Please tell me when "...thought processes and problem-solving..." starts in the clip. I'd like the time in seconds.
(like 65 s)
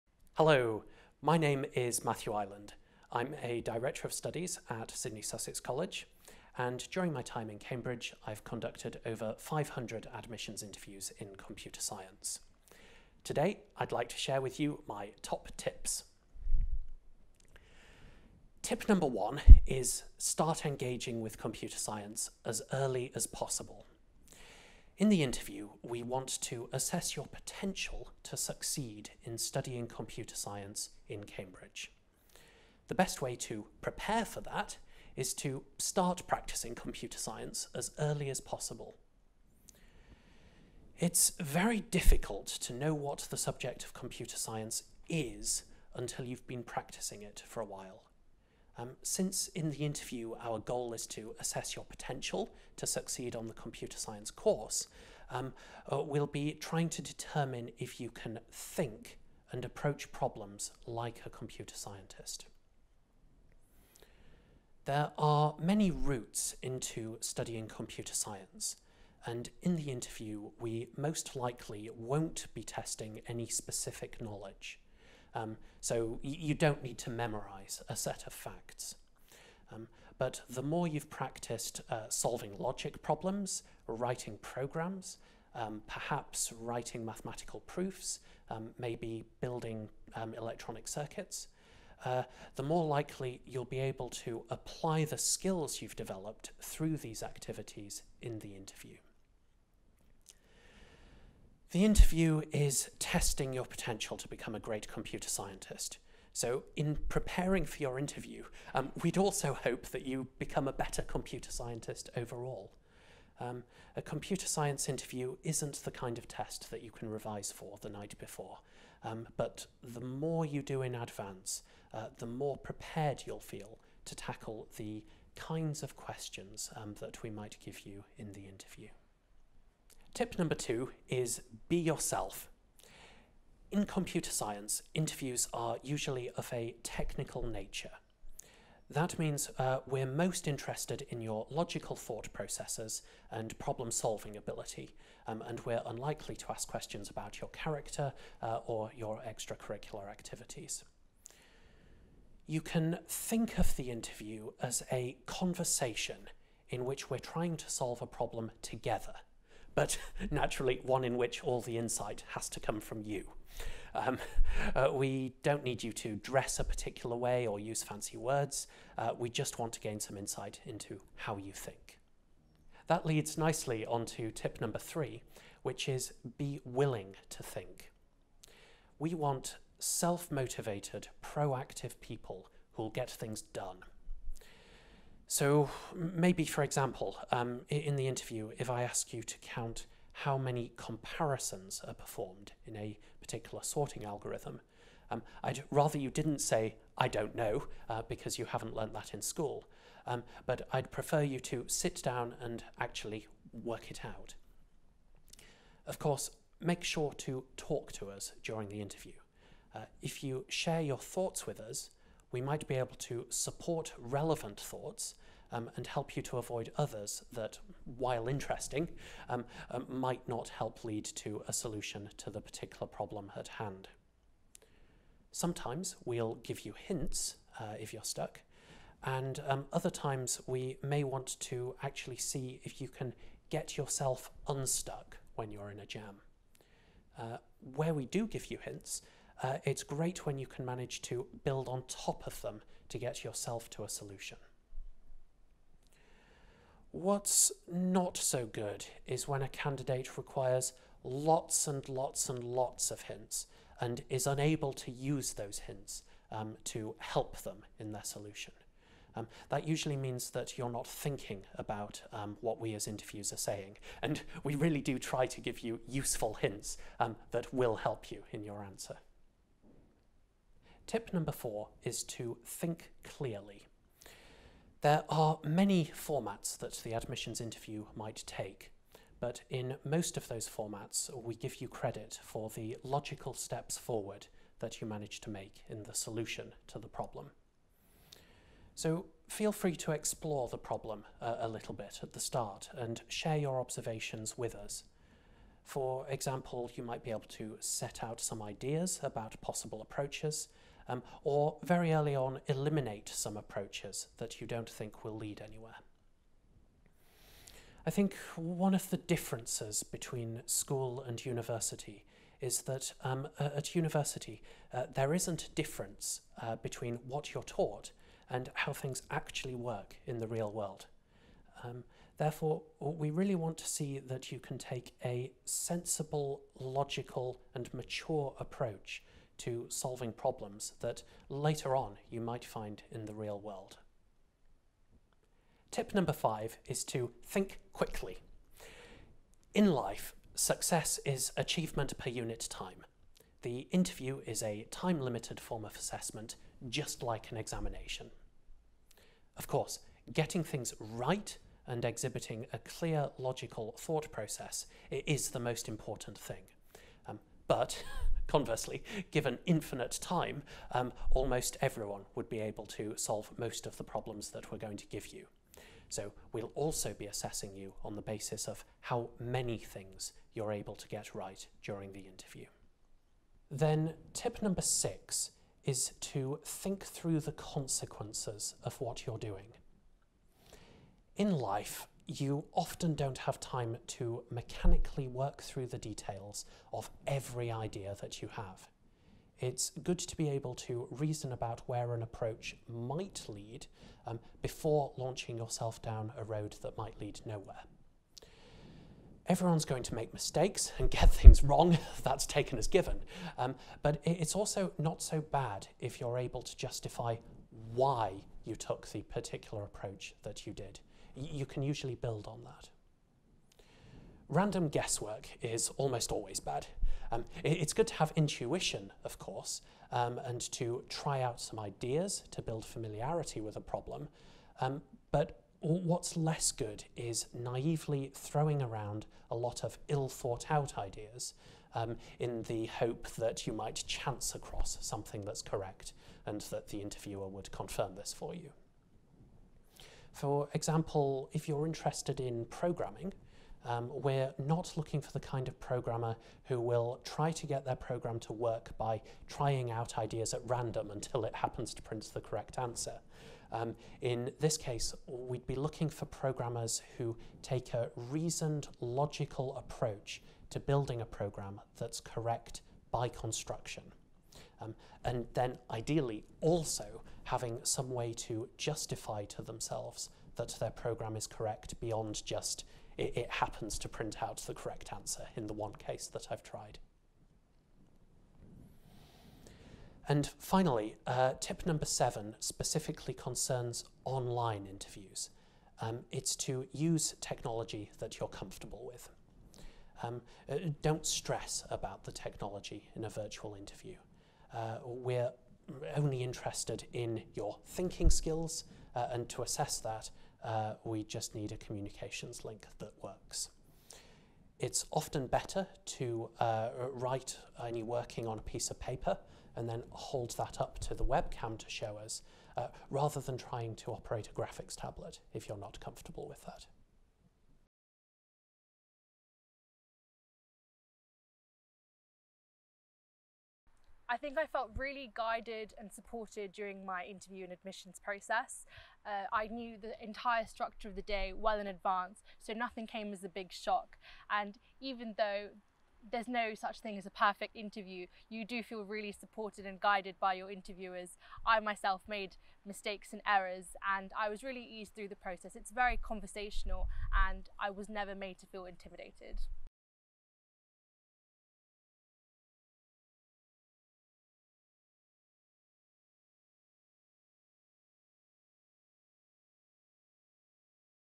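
141 s.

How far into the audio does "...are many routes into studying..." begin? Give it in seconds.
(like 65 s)
65 s.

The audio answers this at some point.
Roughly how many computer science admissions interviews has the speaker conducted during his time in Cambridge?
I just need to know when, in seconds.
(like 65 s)
9 s.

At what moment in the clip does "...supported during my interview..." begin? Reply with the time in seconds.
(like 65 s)
525 s.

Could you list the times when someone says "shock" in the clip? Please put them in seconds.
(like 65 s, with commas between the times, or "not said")
533 s.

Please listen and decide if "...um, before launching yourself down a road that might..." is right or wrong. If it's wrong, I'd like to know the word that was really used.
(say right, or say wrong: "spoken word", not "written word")
right.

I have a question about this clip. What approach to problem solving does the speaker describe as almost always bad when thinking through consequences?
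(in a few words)
Random guesswork.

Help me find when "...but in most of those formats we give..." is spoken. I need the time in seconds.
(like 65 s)
279 s.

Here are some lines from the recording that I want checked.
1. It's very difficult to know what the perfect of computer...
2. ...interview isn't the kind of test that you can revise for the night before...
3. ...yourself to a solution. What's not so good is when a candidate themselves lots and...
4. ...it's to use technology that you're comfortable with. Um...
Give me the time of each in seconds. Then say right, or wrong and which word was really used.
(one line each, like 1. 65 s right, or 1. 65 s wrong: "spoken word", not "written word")
1. 40 s wrong: "subject", not "perfect"
2. 114 s right
3. 243 s wrong: "requires", not "themselves"
4. 486 s right.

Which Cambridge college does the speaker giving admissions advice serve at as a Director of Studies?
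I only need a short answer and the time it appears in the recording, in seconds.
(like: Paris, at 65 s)
Sidney Sussex College, at 4 s.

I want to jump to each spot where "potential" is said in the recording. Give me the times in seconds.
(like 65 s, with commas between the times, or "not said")
27 s, 51 s, 103 s.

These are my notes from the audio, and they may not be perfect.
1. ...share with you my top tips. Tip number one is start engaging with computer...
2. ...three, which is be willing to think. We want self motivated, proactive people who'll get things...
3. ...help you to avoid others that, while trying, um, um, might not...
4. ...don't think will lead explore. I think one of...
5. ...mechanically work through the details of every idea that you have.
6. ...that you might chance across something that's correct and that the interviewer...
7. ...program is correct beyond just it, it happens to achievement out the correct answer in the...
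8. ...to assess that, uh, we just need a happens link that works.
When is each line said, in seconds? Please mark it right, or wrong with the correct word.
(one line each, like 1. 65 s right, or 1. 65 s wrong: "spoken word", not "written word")
1. 14 s right
2. 174 s right
3. 215 s wrong: "interesting", not "trying"
4. 304 s wrong: "anywhere", not "explore"
5. 384 s right
6. 433 s right
7. 470 s wrong: "print", not "achievement"
8. 499 s wrong: "communications", not "happens".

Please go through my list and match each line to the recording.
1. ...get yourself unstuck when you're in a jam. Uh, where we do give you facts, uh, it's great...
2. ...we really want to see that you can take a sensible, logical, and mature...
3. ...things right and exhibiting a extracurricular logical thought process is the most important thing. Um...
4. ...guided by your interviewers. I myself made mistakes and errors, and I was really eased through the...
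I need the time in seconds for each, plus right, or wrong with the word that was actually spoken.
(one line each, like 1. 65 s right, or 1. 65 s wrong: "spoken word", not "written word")
1. 233 s wrong: "hints", not "facts"
2. 322 s right
3. 350 s wrong: "clear", not "extracurricular"
4. 539 s right.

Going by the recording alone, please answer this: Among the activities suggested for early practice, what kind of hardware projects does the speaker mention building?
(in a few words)
electronic circuits.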